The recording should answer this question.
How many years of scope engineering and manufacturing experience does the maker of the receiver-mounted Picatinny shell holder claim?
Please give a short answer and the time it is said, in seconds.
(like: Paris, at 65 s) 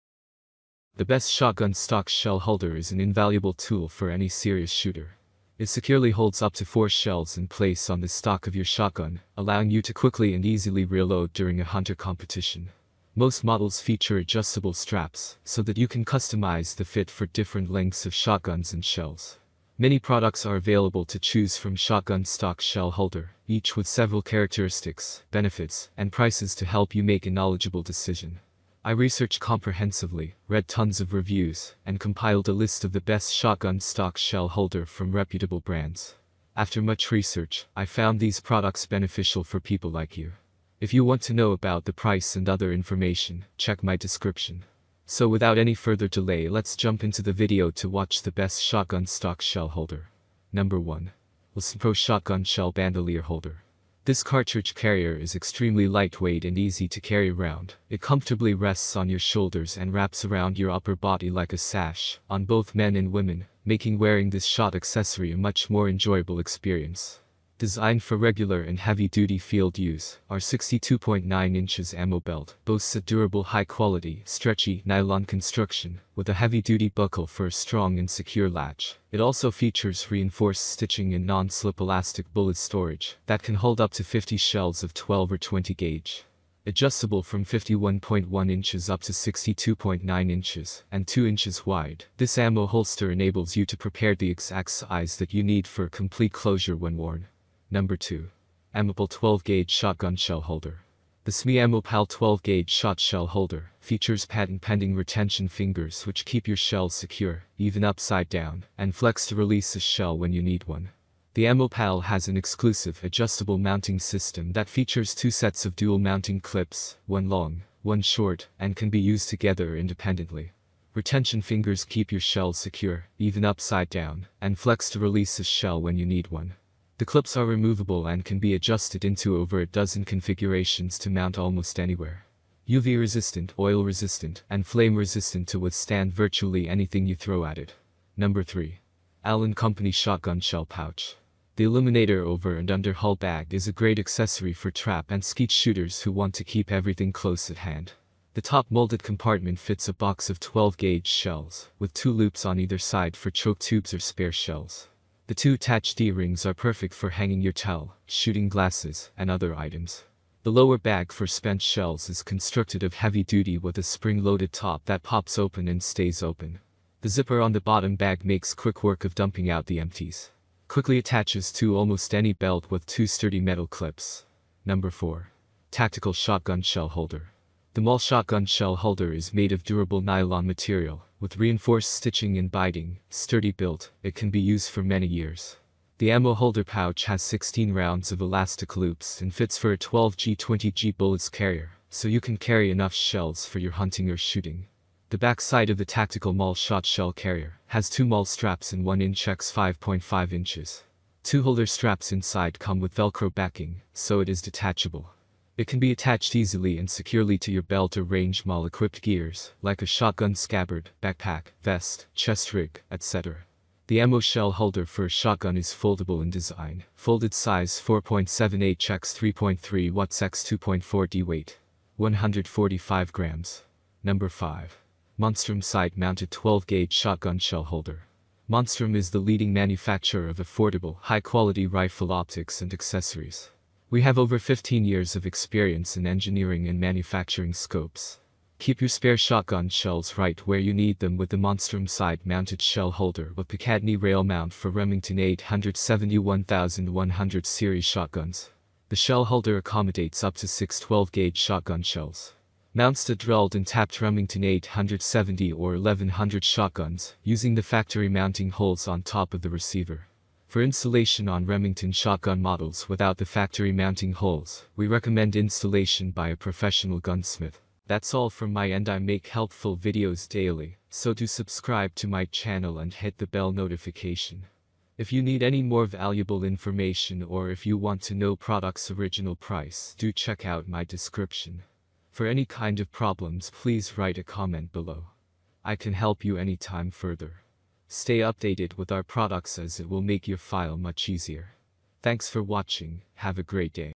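15 years, at 234 s.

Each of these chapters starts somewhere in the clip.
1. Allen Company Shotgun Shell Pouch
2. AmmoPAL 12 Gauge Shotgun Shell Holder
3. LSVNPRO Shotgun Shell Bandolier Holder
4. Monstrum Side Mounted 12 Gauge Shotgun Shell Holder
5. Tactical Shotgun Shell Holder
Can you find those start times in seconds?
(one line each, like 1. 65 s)
1. 137 s
2. 97 s
3. 50 s
4. 223 s
5. 174 s.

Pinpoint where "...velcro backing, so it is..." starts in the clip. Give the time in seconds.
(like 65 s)
202 s.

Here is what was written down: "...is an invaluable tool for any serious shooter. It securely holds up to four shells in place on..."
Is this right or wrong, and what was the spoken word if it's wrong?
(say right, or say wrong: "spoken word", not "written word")
right.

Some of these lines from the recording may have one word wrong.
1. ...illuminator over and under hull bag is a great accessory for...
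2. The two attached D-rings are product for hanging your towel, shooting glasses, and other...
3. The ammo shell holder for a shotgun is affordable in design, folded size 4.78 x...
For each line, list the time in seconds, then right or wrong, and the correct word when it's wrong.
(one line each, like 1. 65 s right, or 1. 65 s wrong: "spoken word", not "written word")
1. 141 s right
2. 155 s wrong: "perfect", not "product"
3. 213 s wrong: "foldable", not "affordable".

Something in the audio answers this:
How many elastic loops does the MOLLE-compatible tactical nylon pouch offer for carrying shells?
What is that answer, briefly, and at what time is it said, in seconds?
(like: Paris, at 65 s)
16, at 187 s.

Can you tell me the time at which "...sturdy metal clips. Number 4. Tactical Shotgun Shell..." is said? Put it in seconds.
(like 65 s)
173 s.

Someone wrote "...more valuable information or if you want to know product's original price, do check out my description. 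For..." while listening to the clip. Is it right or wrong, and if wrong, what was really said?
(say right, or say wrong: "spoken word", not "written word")
right.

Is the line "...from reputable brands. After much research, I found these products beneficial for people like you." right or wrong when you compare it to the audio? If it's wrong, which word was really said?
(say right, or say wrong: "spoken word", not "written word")
right.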